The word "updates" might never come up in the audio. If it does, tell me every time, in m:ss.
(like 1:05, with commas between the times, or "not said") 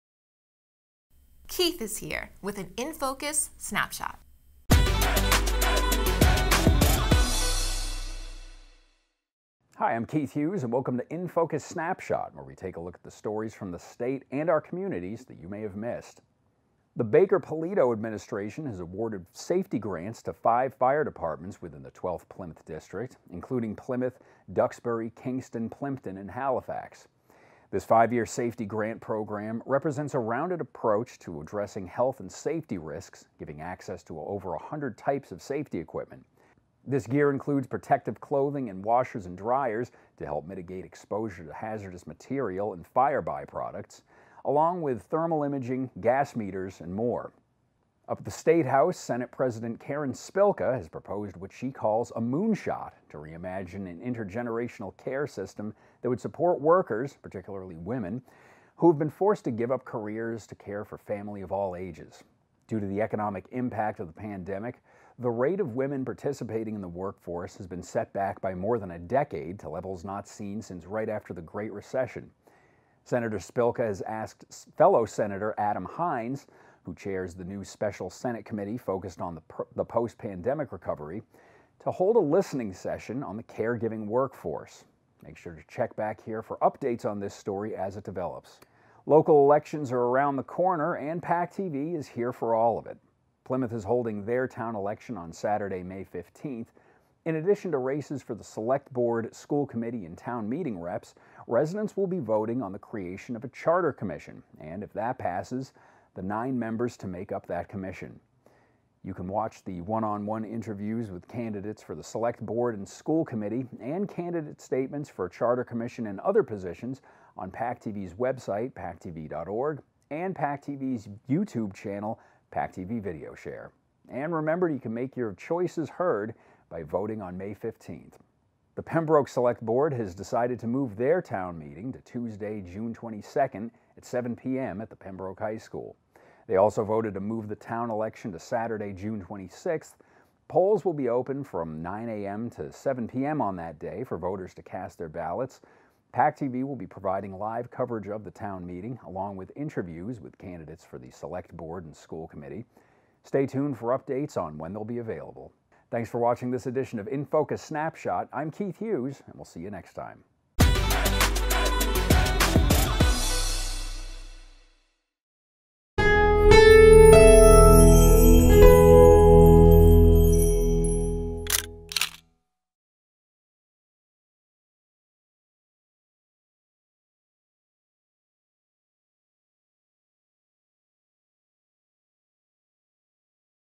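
1:26, 2:33.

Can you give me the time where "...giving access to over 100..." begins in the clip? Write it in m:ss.
0:33.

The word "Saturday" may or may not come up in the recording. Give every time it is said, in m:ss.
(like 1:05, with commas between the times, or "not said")
1:35, 2:18.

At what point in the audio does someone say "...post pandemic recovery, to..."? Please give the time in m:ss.
1:19.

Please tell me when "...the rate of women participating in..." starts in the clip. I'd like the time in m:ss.
1:05.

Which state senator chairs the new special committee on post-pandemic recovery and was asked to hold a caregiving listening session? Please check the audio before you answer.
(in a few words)
Adam Hinds.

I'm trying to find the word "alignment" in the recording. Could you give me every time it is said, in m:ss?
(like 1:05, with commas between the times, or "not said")
not said.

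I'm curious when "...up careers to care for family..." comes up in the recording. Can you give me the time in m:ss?
0:59.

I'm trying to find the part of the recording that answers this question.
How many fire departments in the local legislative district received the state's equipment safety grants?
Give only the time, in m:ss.
0:20.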